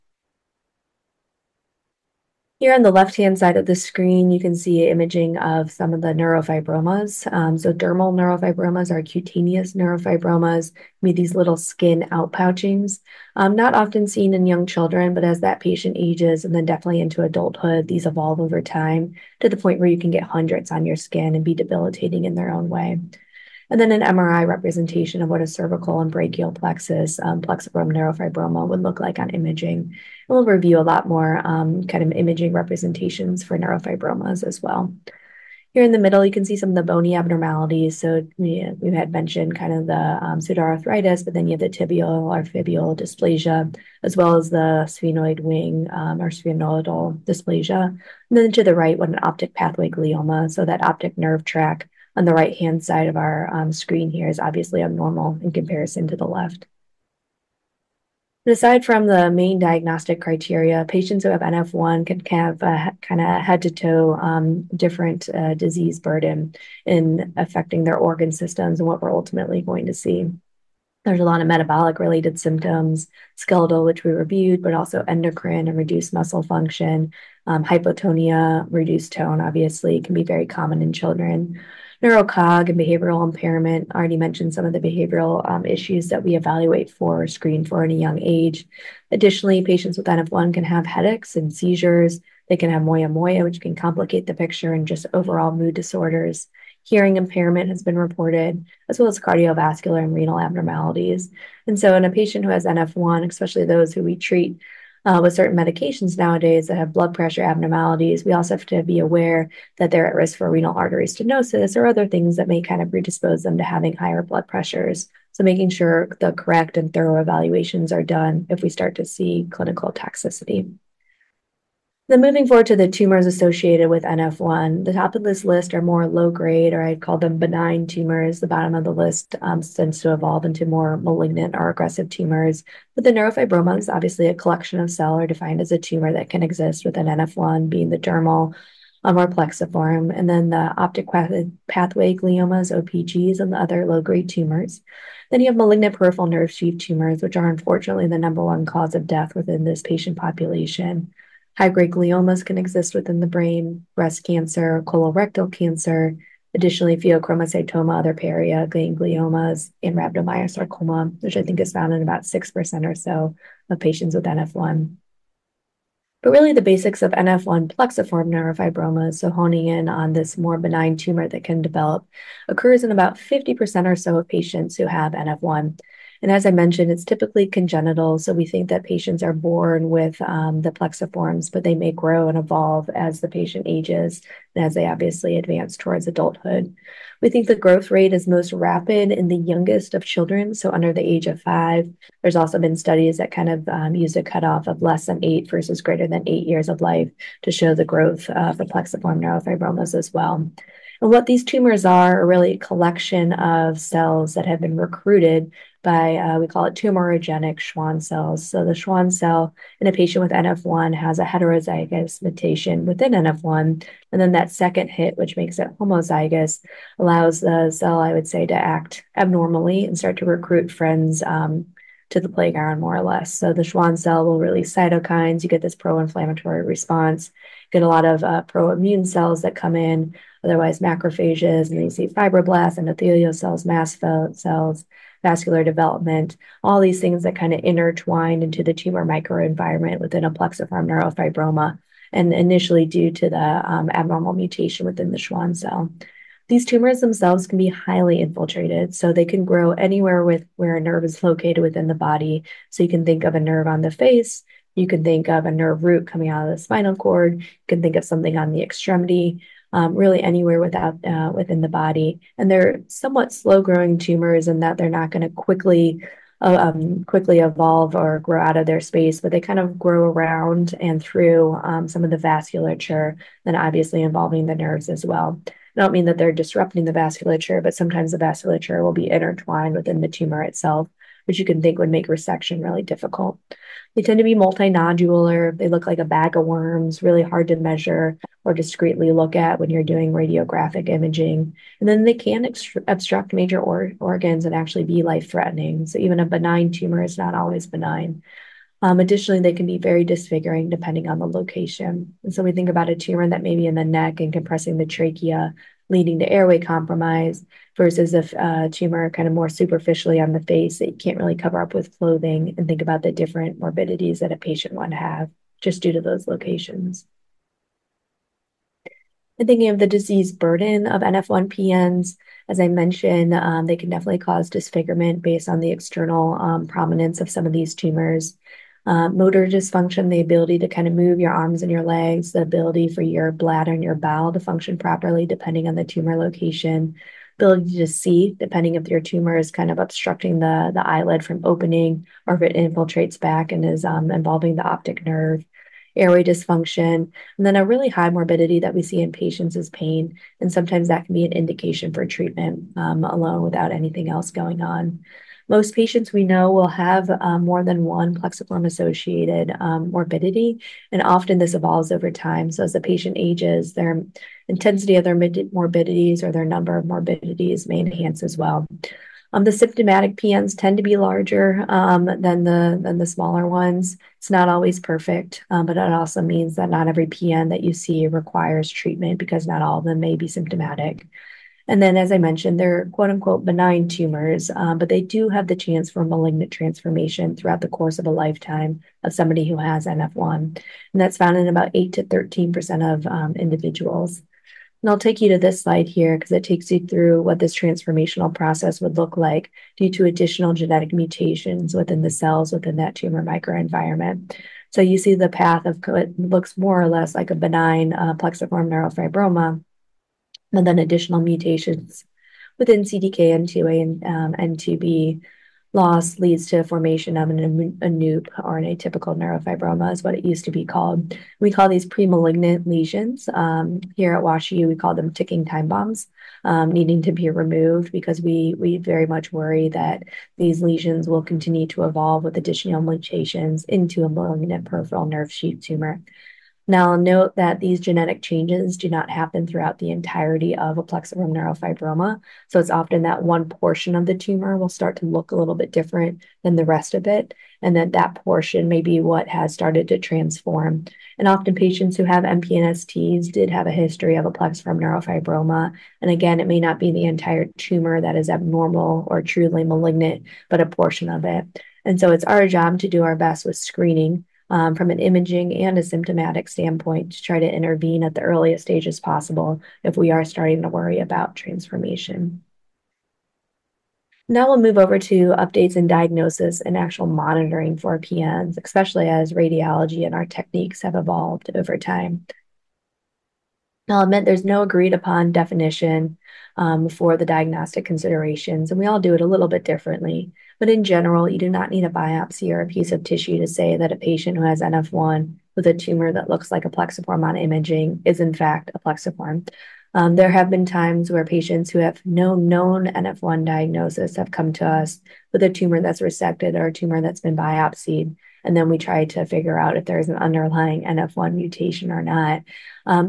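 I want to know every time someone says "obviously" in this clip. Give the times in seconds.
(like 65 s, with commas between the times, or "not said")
54 s, 79 s, 133 s, 184 s, 273 s.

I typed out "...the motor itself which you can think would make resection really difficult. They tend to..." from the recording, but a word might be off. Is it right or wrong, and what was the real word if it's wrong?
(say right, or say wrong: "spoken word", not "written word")
wrong: "tumor", not "motor".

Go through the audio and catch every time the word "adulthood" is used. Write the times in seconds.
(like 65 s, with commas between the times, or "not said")
17 s, 186 s.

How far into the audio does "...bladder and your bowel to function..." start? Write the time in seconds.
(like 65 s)
333 s.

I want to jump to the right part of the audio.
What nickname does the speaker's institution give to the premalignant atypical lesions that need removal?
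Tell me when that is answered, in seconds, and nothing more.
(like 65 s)
425 s.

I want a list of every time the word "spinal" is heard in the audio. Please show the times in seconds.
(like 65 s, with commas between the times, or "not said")
256 s.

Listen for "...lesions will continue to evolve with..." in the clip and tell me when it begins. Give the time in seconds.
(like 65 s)
430 s.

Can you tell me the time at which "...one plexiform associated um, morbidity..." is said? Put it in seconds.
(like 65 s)
357 s.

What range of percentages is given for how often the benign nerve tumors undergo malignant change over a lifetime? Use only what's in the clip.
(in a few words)
8 to 13%.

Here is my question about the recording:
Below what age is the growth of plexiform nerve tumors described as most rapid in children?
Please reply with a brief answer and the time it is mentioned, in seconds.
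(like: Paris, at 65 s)
5, at 191 s.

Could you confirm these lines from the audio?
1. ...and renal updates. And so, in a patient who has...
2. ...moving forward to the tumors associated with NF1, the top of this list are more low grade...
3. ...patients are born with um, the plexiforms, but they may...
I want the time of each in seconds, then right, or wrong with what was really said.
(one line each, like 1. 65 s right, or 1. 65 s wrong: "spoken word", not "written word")
1. 100 s wrong: "abnormalities", not "updates"
2. 122 s right
3. 178 s right.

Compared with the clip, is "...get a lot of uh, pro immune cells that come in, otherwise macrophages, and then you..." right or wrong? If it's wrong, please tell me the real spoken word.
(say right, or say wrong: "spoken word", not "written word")
right.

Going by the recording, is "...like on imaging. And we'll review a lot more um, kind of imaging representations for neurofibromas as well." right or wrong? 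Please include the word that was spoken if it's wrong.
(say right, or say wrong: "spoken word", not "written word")
right.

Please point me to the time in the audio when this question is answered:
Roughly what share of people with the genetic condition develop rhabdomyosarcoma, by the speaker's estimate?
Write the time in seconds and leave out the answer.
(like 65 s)
162 s.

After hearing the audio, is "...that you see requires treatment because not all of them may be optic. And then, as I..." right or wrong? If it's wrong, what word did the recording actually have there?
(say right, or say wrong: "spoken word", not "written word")
wrong: "symptomatic", not "optic".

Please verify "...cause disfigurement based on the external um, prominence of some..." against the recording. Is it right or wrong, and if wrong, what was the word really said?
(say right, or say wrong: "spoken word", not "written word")
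right.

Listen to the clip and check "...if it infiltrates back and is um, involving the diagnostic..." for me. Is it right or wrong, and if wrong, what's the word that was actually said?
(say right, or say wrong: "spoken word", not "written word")
wrong: "optic", not "diagnostic".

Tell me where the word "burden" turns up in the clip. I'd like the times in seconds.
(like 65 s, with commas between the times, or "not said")
65 s, 320 s.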